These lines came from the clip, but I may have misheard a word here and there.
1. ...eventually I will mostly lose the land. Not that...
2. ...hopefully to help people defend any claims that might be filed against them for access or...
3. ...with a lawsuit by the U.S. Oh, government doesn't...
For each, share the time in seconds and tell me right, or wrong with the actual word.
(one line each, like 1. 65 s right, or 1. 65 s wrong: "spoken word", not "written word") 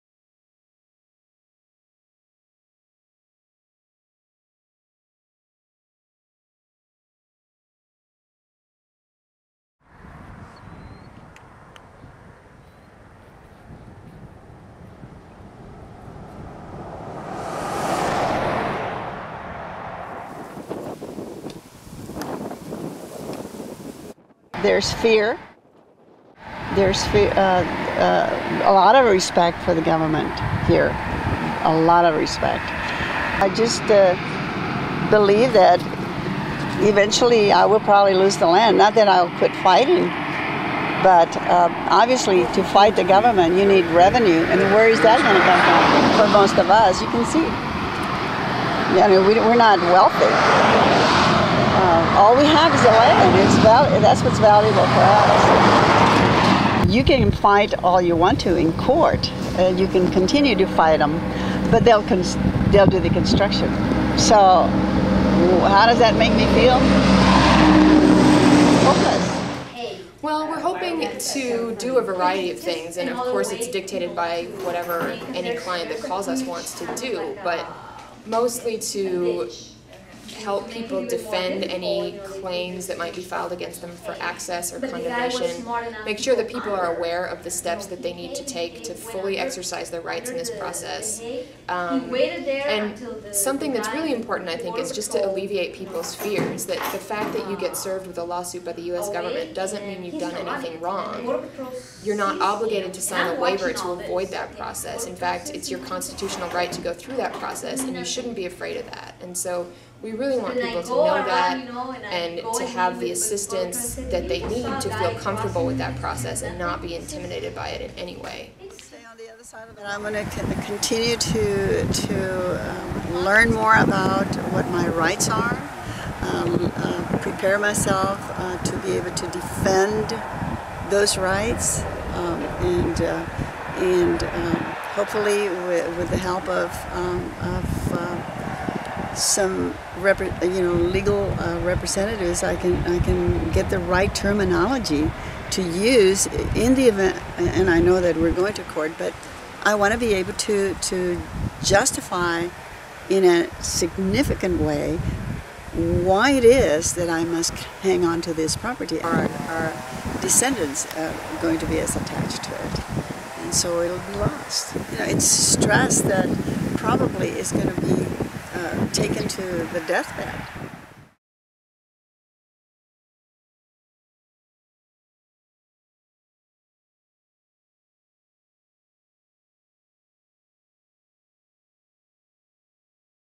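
1. 36 s wrong: "probably", not "mostly"
2. 78 s wrong: "mostly", not "hopefully"
3. 98 s right.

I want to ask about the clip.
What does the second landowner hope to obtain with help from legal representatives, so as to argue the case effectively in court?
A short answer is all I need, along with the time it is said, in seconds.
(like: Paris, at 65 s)
The right terminology, at 143 s.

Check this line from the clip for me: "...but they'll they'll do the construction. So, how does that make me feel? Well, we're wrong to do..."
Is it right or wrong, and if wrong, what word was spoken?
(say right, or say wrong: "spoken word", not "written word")
wrong: "hoping", not "wrong".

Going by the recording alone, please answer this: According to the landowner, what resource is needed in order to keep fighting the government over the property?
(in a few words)
Revenue.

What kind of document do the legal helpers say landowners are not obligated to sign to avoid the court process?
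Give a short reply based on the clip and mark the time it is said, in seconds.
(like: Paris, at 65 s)
A waiver, at 103 s.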